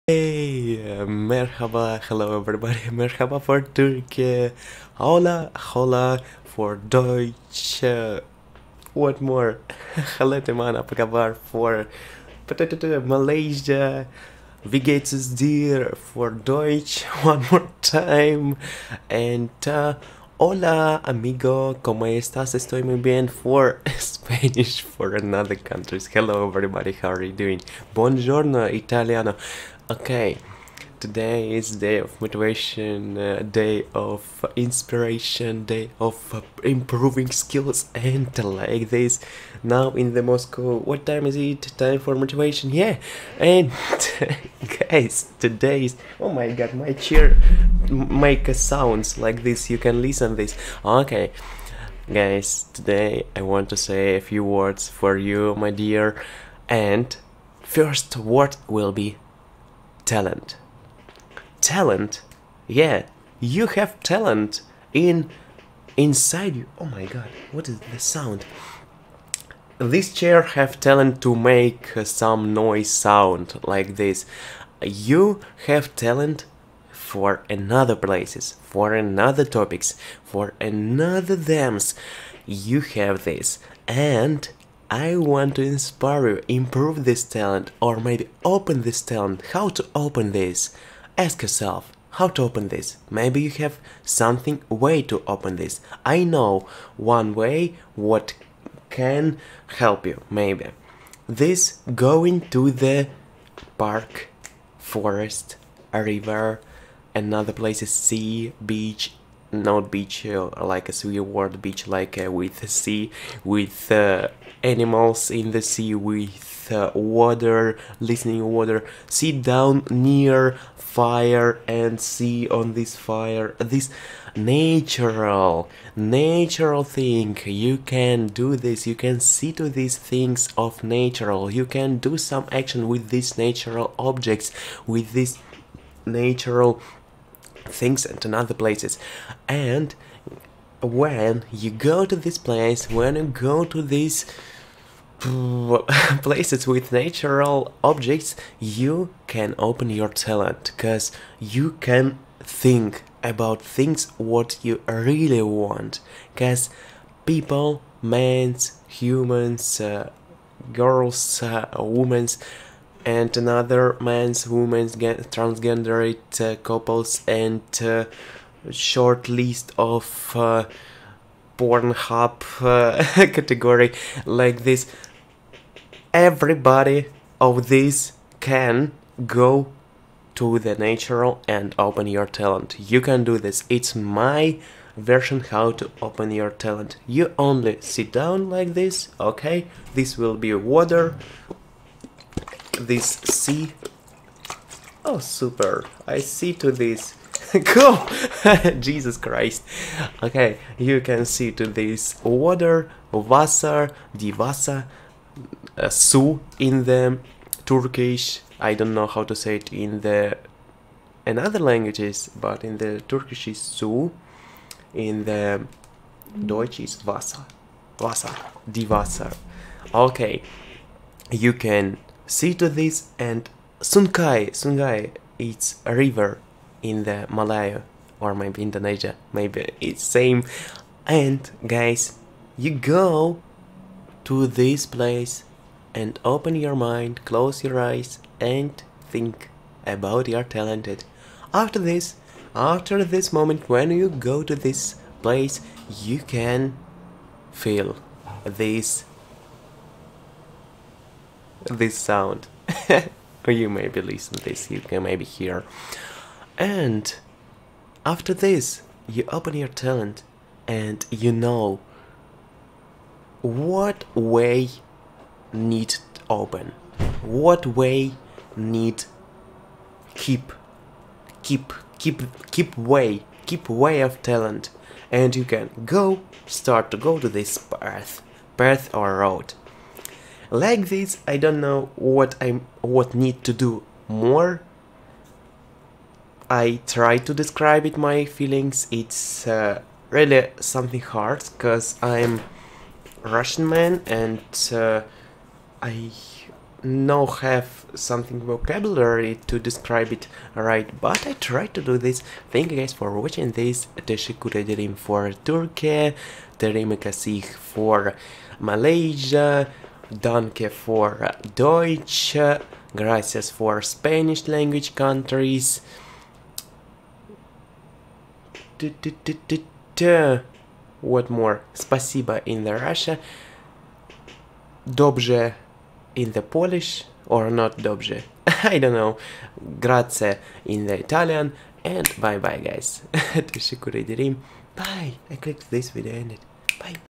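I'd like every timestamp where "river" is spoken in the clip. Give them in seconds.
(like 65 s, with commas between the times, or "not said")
105 s, 225 s.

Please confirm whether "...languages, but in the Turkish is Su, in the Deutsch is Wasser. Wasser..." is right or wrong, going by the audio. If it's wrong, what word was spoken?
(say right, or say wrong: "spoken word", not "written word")
right.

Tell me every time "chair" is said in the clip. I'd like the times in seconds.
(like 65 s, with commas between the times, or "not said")
46 s, 70 s.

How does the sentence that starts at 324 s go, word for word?
Dobrze in the Polish or not dobrze.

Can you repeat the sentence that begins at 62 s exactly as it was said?
Yeah, you have talent in inside you.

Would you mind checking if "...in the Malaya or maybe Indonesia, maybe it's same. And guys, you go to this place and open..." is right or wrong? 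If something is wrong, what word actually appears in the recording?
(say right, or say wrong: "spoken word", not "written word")
right.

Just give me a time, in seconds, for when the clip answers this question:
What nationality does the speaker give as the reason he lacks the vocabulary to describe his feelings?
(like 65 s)
293 s.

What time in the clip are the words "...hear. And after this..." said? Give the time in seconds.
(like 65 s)
255 s.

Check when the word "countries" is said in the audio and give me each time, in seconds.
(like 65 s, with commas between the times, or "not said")
25 s, 314 s.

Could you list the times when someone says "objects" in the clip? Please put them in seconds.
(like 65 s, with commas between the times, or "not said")
133 s, 147 s.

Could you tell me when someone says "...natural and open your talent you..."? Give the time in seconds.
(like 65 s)
180 s.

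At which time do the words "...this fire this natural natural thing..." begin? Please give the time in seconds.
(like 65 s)
122 s.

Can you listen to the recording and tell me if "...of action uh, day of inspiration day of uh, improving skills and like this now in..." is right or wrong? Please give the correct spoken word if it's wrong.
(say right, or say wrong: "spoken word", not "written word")
wrong: "motivation", not "action".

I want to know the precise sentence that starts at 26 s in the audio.
Hello everybody, how are you doing?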